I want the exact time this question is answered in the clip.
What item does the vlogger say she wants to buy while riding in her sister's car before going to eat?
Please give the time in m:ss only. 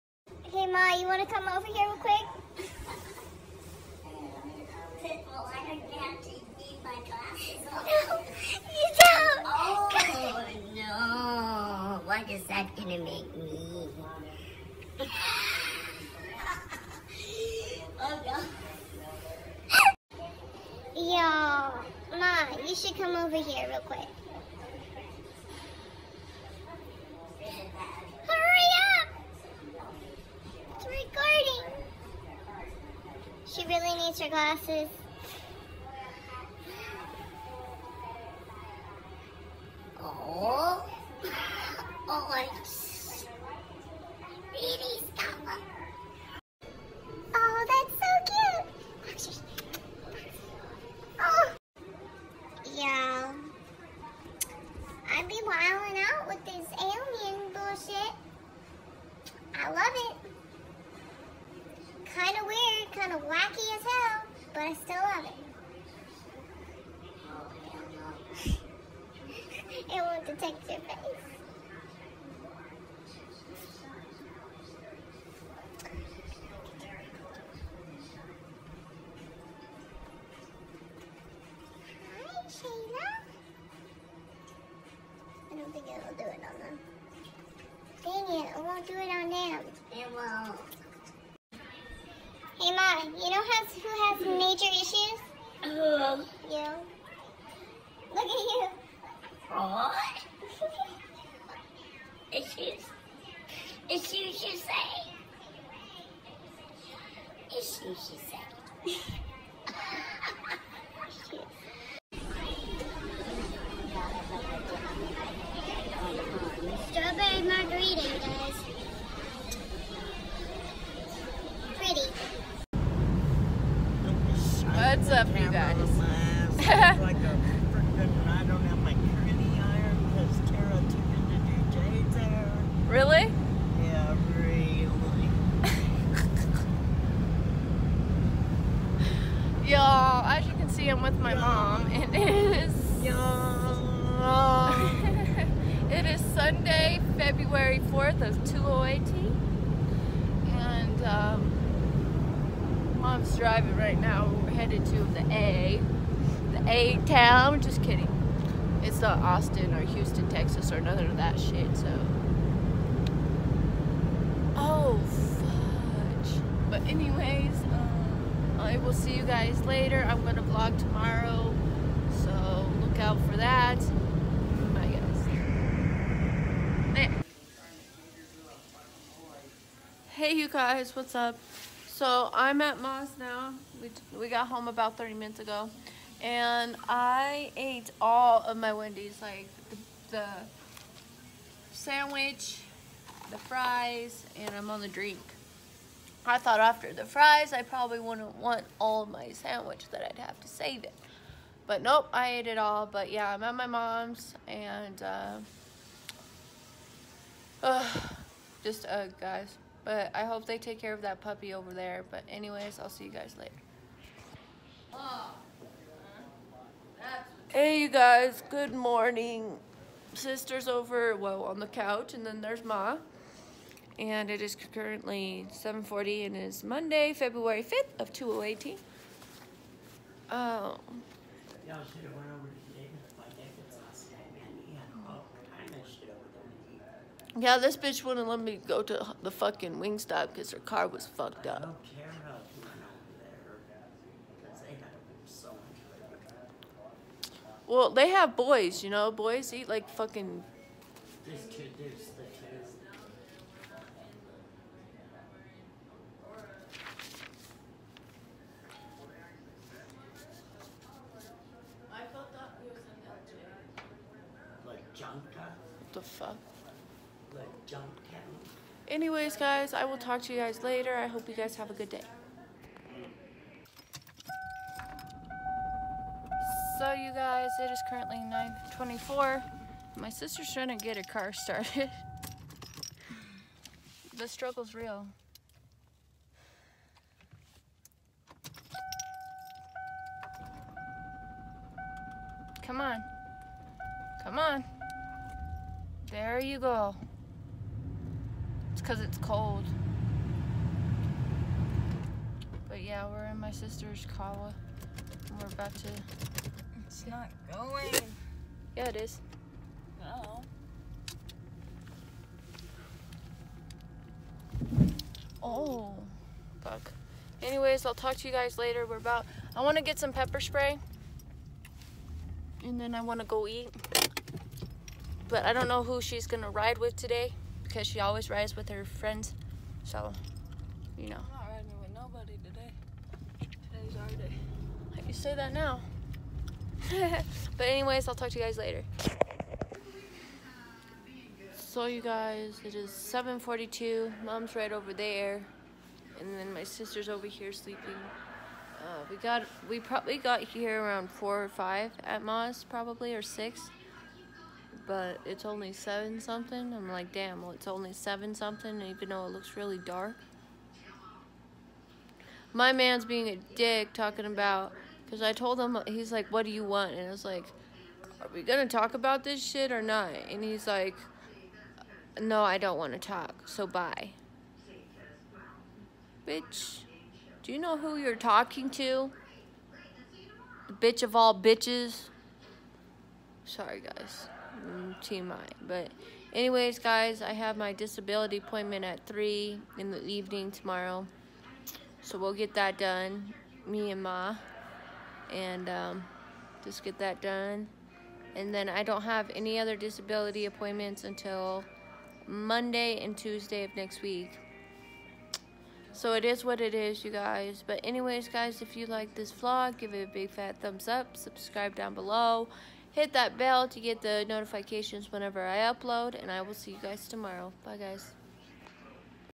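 5:20.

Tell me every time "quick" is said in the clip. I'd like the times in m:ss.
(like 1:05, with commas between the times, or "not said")
0:01, 0:23.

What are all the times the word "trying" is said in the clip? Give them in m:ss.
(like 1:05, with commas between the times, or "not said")
4:40.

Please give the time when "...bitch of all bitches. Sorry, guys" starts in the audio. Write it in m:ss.
6:20.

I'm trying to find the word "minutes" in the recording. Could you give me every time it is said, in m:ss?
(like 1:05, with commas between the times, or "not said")
3:05.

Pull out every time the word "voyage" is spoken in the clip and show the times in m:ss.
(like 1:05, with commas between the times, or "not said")
not said.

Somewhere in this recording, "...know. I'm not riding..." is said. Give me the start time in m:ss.
5:31.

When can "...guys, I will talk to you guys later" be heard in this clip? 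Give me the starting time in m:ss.
4:29.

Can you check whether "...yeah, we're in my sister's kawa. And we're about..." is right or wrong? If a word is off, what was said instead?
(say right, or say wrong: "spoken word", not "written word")
right.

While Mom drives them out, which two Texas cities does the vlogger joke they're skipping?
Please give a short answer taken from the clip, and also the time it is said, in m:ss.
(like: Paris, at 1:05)
Austin or Houston, at 2:39.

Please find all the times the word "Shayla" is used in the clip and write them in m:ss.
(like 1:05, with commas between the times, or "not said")
1:22.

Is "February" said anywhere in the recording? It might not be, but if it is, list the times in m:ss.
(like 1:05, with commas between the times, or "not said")
2:27, 3:47.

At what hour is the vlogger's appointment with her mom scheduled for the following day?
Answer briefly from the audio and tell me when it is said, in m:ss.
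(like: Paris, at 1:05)
3, at 6:29.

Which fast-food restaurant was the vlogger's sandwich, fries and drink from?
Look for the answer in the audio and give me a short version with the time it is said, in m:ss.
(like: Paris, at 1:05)
Wendy's, at 3:08.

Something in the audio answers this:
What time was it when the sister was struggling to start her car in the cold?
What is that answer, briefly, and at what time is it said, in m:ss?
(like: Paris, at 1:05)
9:24, at 4:38.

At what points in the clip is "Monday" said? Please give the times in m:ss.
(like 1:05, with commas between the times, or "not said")
3:46, 6:42.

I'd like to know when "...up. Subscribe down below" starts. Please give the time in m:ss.
6:50.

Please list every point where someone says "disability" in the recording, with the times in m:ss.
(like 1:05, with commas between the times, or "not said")
6:27, 6:39.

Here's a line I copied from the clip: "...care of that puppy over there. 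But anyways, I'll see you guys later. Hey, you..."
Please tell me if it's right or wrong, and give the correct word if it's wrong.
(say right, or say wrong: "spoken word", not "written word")
right.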